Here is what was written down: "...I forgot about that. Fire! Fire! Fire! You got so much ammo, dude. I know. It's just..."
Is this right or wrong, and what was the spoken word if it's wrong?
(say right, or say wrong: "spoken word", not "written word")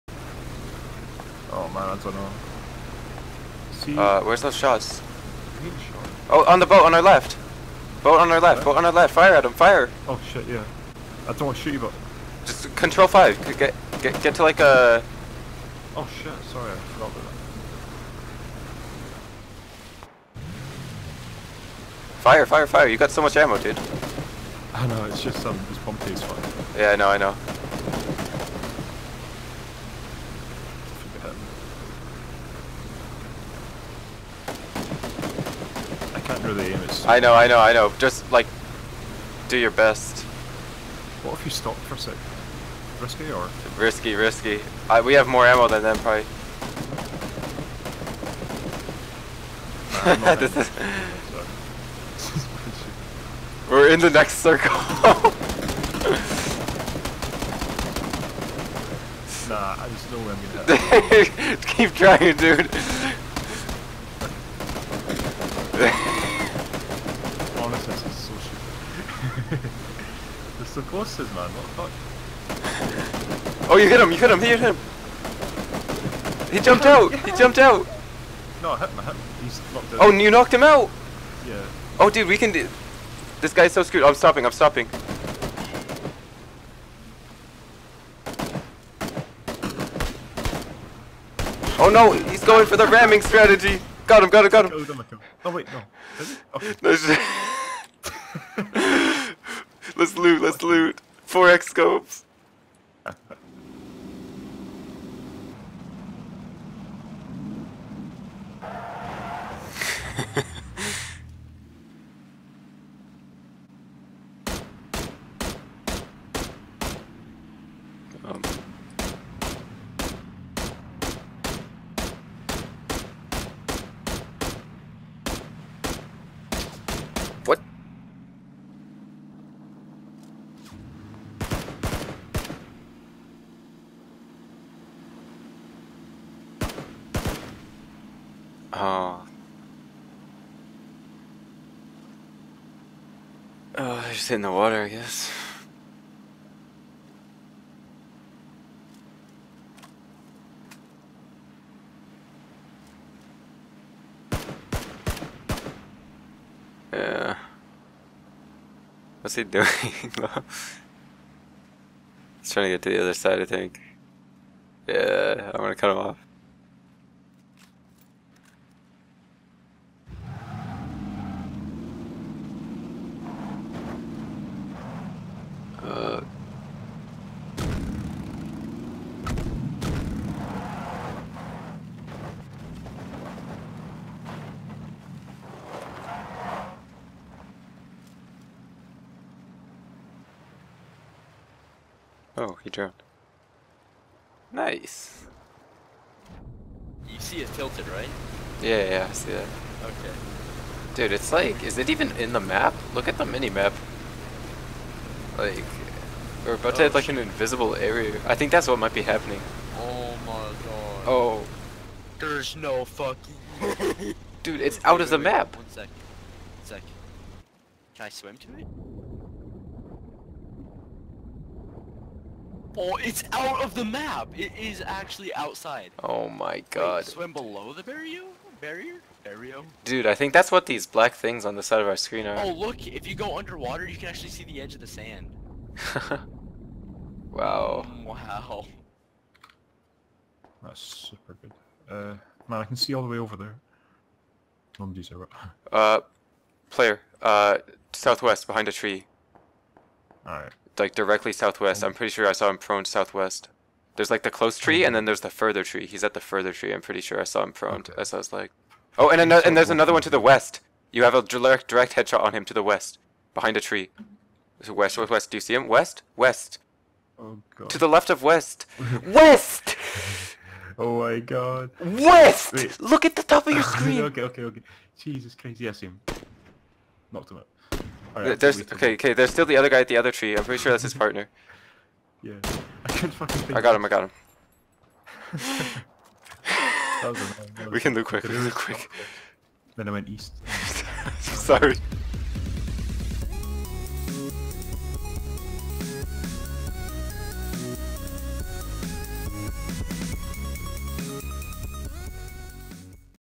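right.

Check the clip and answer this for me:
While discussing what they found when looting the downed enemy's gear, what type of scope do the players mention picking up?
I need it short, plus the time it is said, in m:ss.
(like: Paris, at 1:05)
4x scopes, at 1:41.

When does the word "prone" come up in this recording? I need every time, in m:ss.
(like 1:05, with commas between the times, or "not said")
4:12, 4:17.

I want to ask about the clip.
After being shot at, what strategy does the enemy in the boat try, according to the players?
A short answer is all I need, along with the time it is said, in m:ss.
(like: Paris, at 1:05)
Ramming strategy, at 1:32.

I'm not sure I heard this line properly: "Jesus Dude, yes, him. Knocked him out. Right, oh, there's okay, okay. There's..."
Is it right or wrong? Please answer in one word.
wrong.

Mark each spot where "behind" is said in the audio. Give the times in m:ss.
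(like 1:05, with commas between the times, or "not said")
4:08, 4:23.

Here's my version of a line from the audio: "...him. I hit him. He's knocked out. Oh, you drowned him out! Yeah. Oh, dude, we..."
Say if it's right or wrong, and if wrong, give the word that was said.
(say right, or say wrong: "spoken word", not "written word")
wrong: "knocked", not "drowned".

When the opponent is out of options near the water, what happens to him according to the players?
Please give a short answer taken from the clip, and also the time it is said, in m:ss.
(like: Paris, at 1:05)
He drowned, at 3:12.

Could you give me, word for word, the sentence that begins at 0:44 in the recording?
I, we have more ammo than them, probably.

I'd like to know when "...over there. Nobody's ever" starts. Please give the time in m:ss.
4:03.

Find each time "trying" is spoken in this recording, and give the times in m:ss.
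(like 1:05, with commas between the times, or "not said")
1:01, 2:42.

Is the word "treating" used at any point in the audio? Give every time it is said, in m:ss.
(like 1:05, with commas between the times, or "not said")
not said.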